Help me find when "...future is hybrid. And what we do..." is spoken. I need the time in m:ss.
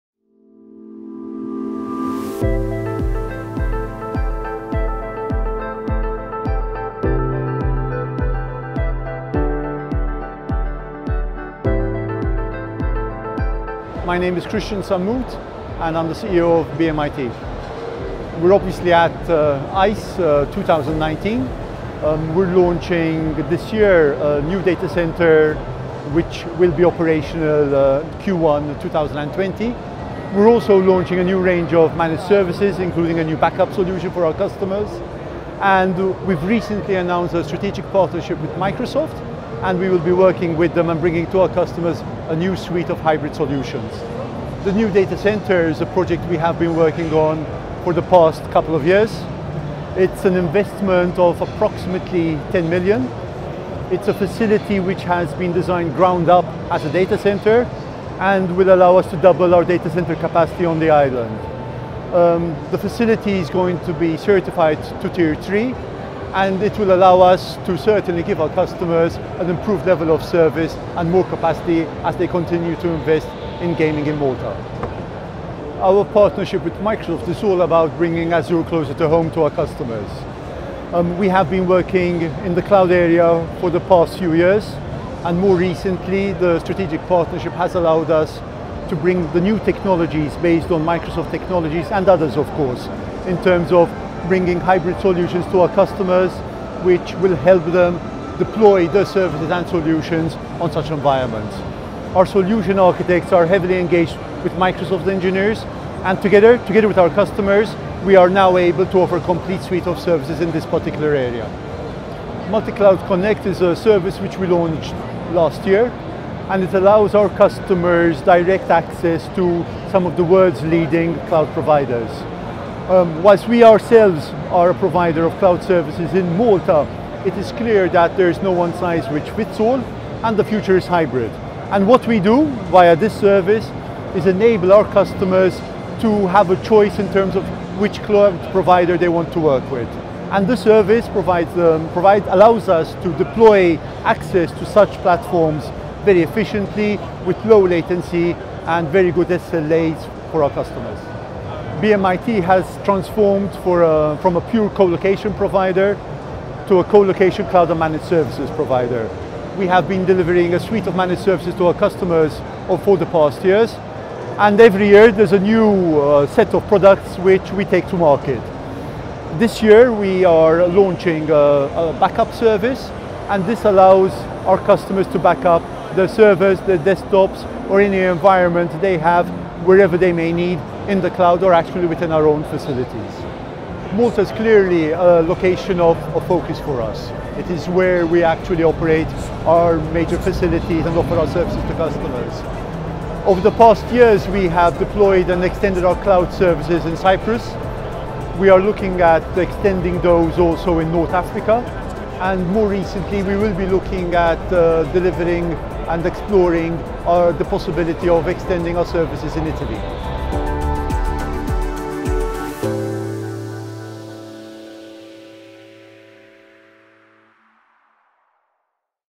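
2:10.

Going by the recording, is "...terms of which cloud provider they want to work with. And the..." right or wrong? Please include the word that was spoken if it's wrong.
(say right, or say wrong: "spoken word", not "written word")
right.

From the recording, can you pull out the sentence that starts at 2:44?
And every year there's a new uh, set of products which we take to market.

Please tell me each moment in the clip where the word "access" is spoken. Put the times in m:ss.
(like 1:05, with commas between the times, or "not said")
1:58, 2:24.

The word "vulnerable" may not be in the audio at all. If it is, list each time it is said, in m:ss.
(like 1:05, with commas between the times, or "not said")
not said.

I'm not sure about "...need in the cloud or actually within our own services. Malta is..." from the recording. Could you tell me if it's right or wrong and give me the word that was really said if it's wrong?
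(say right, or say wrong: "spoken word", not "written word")
wrong: "facilities", not "services".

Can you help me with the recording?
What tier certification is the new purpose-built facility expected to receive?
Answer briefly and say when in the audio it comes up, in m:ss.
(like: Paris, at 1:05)
Tier 3, at 1:05.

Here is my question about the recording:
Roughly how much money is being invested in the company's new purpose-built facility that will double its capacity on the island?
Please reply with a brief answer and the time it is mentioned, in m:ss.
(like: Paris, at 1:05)
10 million, at 0:52.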